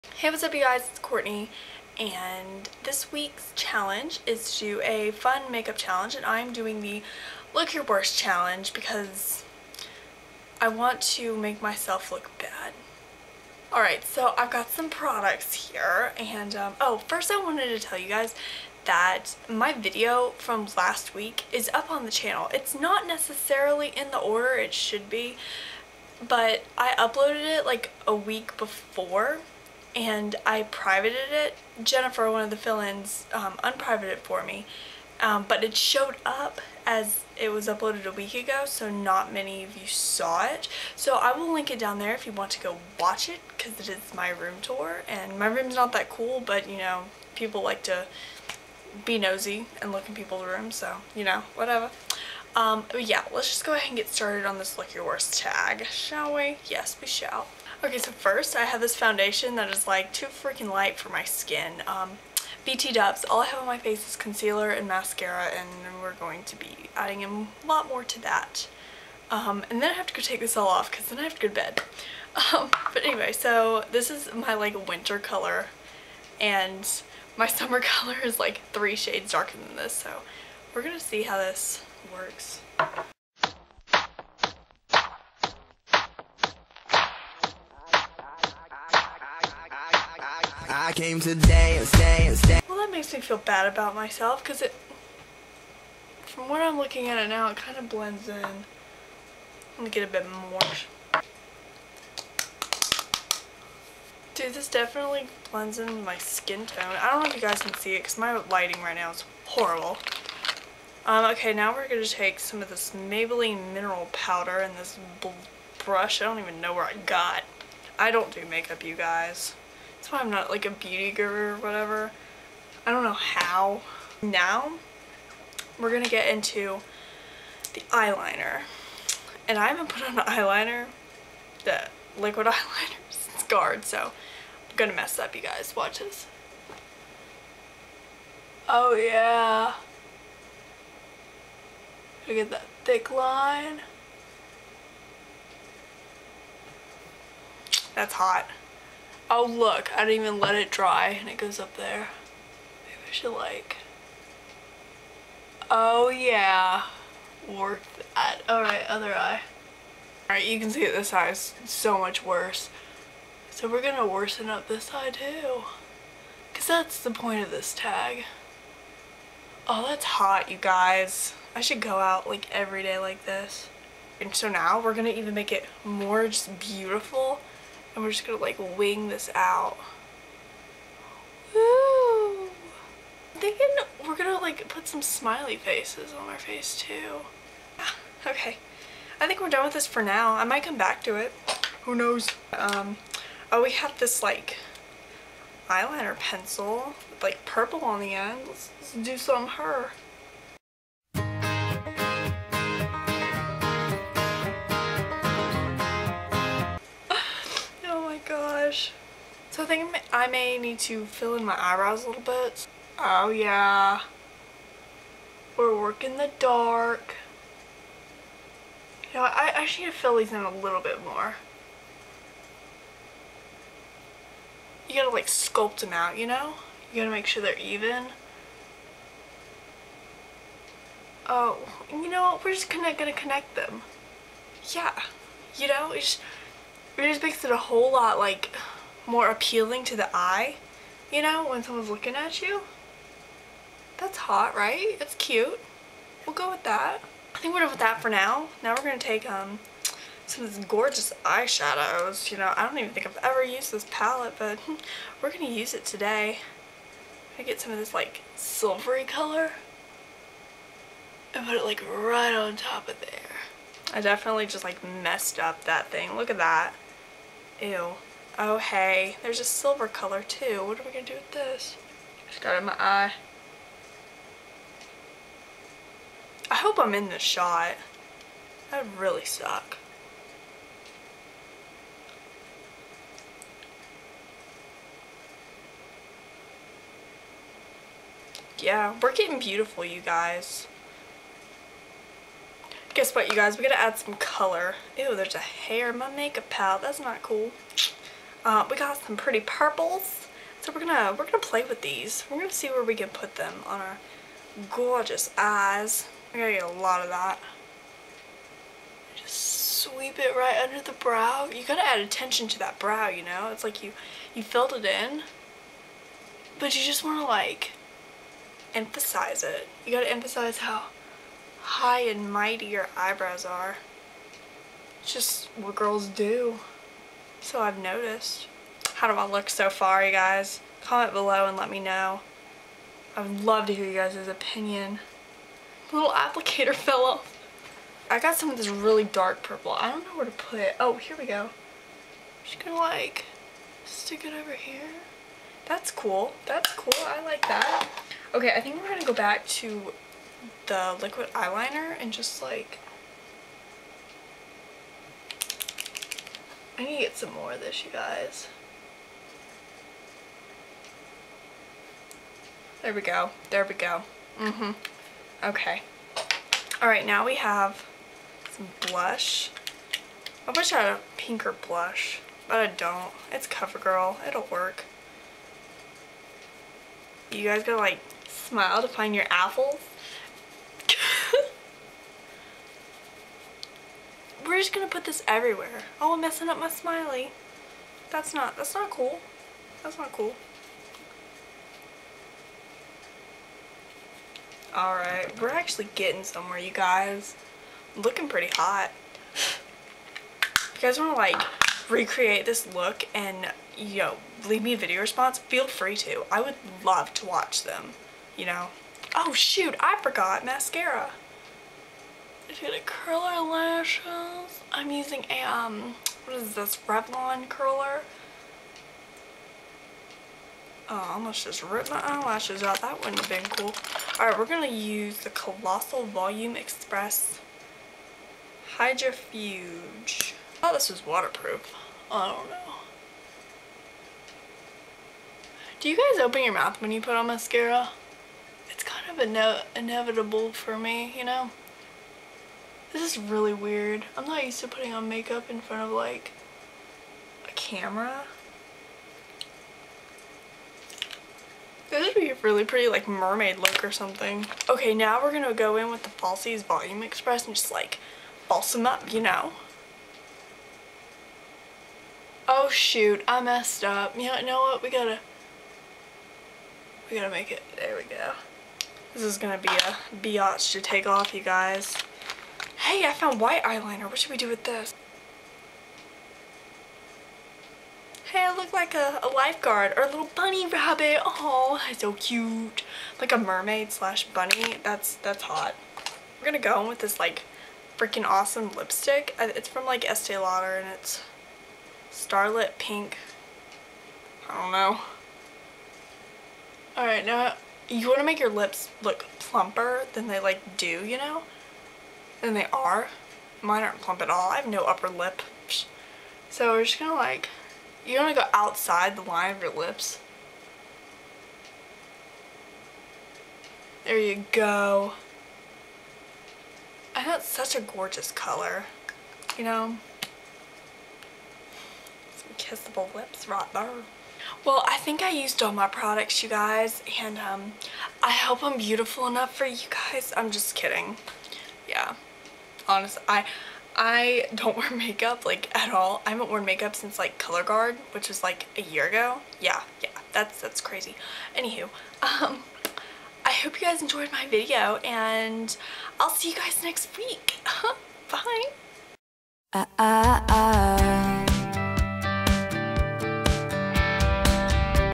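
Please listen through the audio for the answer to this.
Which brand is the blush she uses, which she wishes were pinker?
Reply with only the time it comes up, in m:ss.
6:13.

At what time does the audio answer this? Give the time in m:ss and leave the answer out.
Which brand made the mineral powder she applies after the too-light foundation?
1:52.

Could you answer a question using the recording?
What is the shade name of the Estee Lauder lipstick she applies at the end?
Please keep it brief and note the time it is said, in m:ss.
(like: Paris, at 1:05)
Starlit Pink, at 8:12.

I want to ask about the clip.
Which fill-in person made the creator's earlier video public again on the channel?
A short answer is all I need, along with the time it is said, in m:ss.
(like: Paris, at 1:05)
Jennifer, at 0:31.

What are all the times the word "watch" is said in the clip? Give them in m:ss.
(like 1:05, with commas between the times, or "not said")
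0:42, 2:15, 6:47.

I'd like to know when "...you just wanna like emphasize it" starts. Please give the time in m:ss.
5:16.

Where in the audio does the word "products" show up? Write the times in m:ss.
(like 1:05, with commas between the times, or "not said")
0:14, 8:45.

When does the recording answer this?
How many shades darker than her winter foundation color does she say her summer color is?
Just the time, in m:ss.
1:18.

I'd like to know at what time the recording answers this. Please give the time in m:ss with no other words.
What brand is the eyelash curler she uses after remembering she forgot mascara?
6:56.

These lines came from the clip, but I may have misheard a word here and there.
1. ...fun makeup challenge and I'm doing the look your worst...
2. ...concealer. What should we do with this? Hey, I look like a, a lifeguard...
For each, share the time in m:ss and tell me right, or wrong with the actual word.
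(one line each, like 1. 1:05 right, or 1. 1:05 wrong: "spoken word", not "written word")
1. 0:05 right
2. 7:53 wrong: "eyeliner", not "concealer".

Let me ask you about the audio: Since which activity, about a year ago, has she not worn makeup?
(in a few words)
Color Guard.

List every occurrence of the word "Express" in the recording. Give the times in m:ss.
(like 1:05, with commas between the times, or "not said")
7:06, 7:37.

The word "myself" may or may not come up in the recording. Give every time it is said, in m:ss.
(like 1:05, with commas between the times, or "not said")
0:11, 1:33.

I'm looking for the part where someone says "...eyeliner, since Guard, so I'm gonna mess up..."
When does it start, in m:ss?
2:12.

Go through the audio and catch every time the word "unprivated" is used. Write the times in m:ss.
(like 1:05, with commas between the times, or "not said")
0:33.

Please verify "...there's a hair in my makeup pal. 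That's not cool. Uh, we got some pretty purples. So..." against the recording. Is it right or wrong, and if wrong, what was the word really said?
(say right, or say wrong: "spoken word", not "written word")
right.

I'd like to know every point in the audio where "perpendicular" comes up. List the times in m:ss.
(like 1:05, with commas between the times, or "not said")
not said.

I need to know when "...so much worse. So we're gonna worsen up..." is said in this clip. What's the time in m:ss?
2:41.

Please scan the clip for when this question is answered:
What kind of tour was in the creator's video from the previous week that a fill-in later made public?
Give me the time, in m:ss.
0:44.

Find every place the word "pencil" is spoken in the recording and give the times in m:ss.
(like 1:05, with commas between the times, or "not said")
3:16.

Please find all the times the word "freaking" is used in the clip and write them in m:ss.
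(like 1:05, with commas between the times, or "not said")
1:00, 8:07.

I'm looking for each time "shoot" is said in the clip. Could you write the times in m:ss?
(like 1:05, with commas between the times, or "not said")
6:49, 7:42.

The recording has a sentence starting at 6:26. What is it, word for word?
Oh, I'm messing up my smiley.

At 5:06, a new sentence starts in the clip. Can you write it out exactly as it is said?
I gotta get a lot of that.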